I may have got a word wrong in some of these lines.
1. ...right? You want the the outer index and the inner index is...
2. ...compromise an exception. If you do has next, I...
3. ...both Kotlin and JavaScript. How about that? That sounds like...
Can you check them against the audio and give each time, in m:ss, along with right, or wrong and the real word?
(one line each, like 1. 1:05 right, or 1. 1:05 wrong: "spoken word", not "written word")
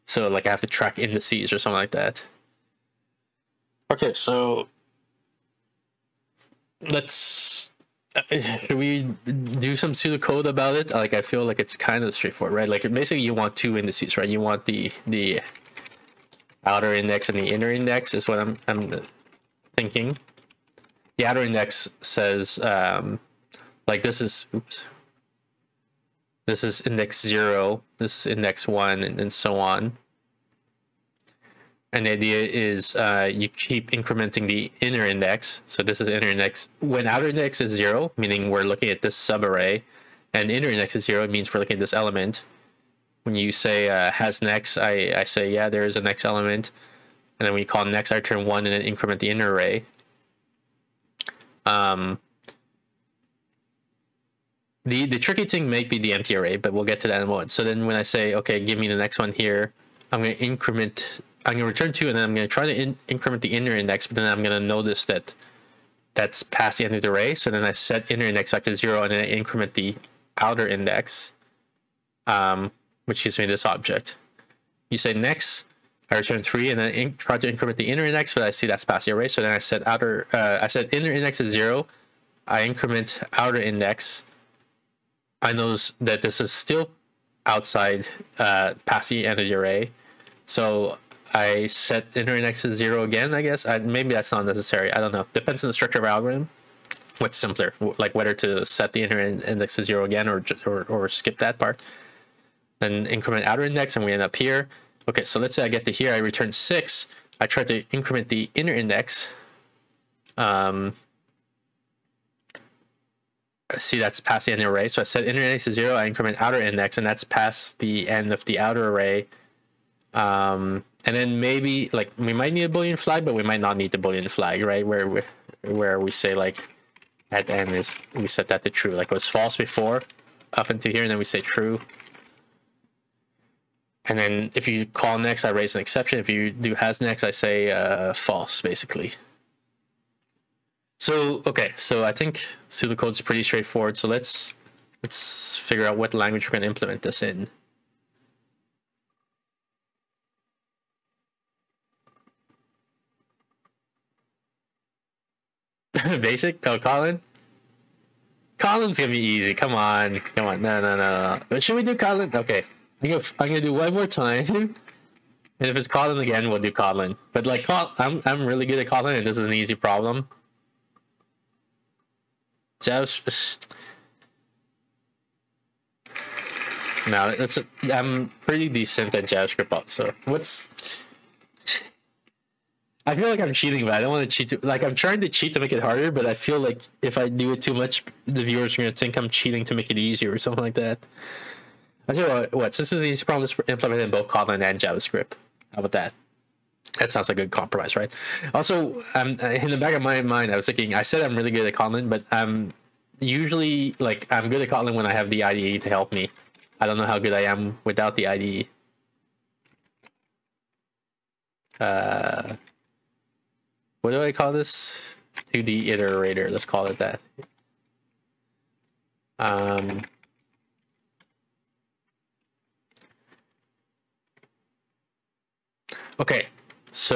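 1. 0:14 right
2. 2:15 wrong: "raise", not "compromise"
3. 3:14 right.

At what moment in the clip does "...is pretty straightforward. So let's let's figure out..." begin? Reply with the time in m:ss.
2:23.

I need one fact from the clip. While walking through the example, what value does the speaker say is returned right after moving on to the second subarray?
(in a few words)
3.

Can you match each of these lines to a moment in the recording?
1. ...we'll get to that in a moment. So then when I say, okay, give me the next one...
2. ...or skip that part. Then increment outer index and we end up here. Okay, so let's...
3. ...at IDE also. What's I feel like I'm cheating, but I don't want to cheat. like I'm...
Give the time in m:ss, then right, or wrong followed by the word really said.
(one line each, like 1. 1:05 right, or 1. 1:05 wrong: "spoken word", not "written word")
1. 0:56 right
2. 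1:40 right
3. 2:59 wrong: "JavaScript", not "IDE".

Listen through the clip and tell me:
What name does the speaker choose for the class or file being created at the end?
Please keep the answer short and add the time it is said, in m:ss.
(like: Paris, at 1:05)
2D iterator, at 3:35.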